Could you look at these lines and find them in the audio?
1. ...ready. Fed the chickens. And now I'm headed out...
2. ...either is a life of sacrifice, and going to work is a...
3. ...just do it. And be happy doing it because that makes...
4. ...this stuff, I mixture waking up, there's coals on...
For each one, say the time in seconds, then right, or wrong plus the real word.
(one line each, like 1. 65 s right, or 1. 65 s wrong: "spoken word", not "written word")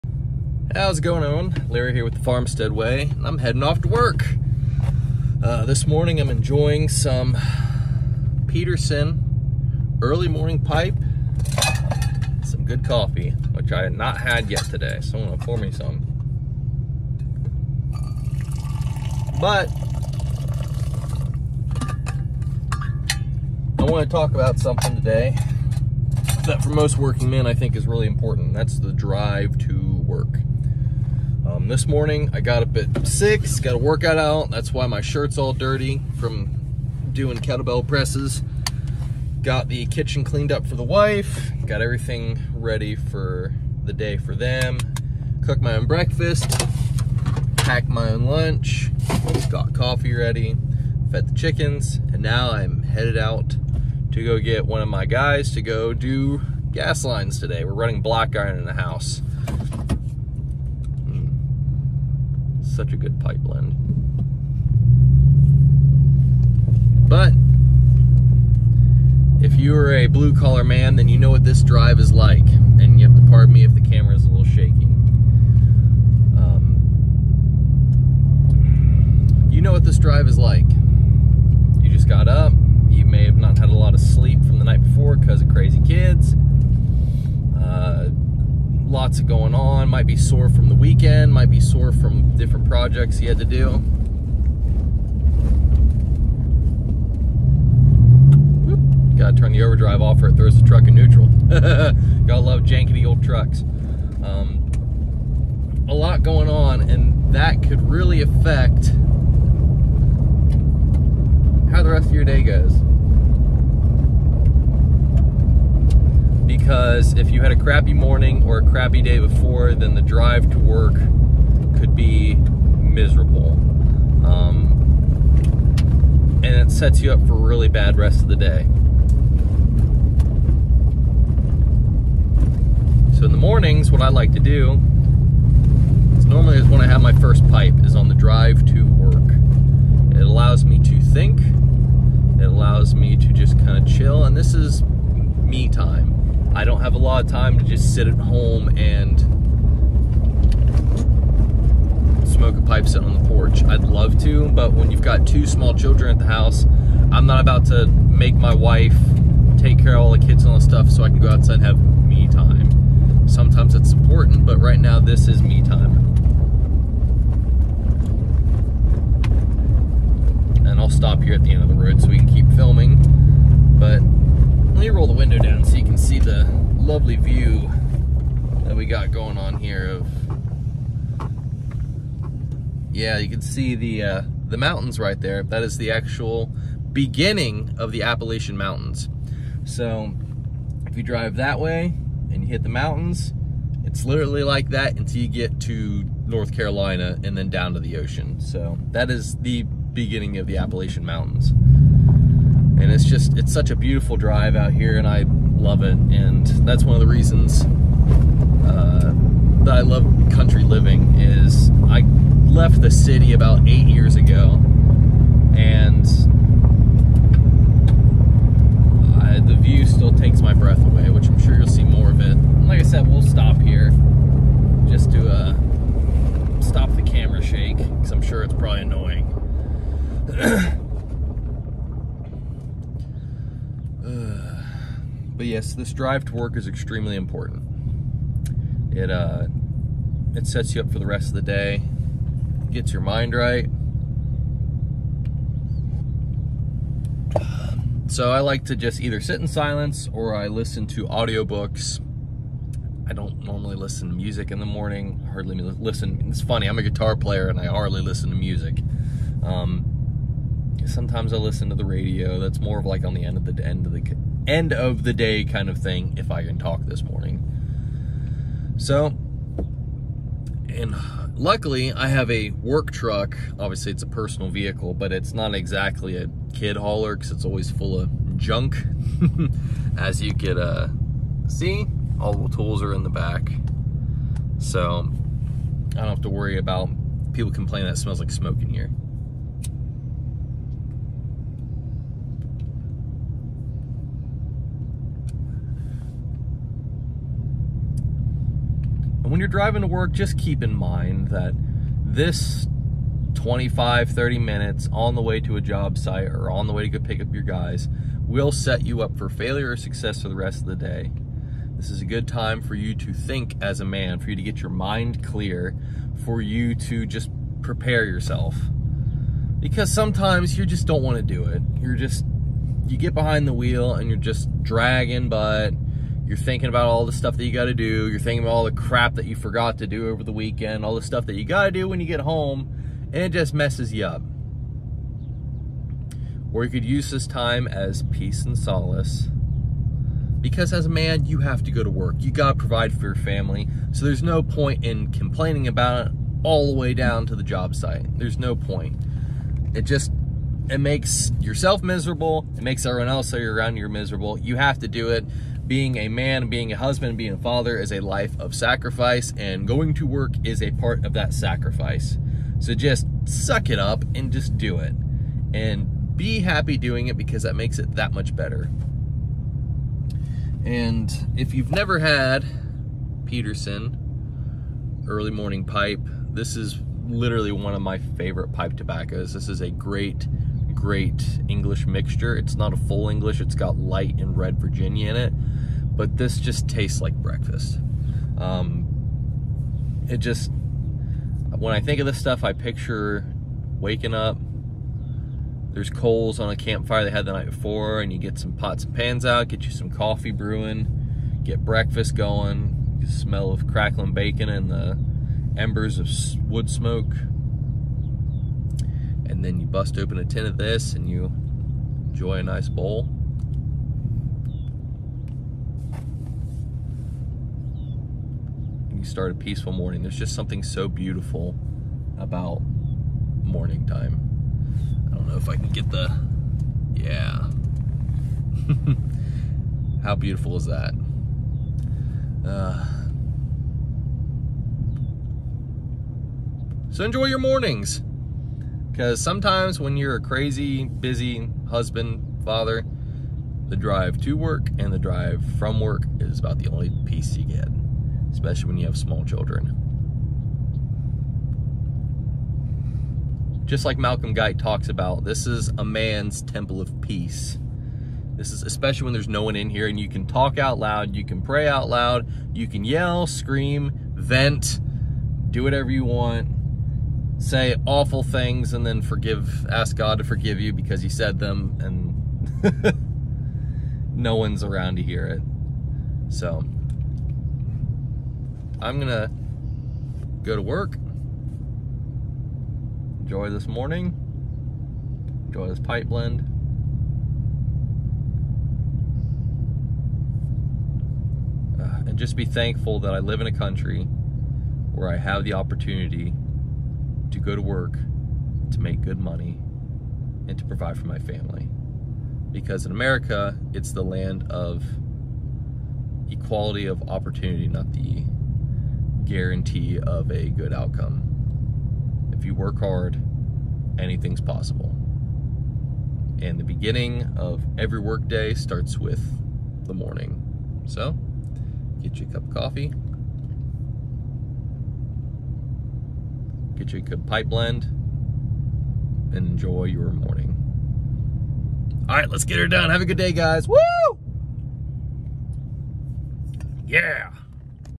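1. 50 s right
2. 357 s wrong: "father", not "either"
3. 364 s right
4. 392 s wrong: "picture", not "mixture".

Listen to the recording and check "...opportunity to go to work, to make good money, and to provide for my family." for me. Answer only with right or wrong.
right.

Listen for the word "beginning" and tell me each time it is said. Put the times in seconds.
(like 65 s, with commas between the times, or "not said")
186 s, 199 s, 516 s.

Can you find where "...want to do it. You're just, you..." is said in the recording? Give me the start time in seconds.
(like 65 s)
321 s.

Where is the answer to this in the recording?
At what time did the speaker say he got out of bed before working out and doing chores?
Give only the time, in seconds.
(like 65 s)
33 s.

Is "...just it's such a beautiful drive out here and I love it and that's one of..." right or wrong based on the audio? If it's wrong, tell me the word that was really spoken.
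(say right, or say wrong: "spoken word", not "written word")
right.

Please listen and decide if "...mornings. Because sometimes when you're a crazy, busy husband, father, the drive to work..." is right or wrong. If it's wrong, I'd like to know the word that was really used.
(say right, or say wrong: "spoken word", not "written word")
right.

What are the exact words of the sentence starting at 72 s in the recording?
And you have to pardon me if the camera is a little shaky.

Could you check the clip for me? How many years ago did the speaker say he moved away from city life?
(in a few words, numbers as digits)
8.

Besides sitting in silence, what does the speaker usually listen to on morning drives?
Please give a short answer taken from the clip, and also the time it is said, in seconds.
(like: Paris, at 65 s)
Audiobooks, at 251 s.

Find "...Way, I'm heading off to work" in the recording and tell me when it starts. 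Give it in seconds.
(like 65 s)
2 s.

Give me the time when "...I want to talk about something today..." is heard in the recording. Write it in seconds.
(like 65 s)
23 s.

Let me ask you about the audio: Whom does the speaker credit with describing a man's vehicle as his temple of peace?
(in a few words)
Malcolm Guy.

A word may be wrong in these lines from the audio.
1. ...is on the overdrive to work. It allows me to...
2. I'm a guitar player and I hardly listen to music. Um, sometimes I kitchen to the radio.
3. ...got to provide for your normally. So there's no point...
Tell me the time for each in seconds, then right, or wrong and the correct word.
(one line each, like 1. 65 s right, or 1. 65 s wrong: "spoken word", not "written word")
1. 137 s wrong: "drive", not "overdrive"
2. 256 s wrong: "listen", not "kitchen"
3. 342 s wrong: "family", not "normally".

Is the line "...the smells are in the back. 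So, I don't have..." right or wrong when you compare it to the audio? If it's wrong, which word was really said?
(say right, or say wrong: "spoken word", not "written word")
wrong: "tools", not "smells".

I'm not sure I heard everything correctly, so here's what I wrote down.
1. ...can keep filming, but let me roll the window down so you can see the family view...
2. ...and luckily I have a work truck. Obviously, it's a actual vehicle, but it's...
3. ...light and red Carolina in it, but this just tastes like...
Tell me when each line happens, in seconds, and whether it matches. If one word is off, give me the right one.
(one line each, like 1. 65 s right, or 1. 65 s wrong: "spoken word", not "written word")
1. 172 s wrong: "lovely", not "family"
2. 270 s wrong: "personal", not "actual"
3. 383 s wrong: "Virginia", not "Carolina".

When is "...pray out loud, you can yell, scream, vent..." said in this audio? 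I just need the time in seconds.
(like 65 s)
461 s.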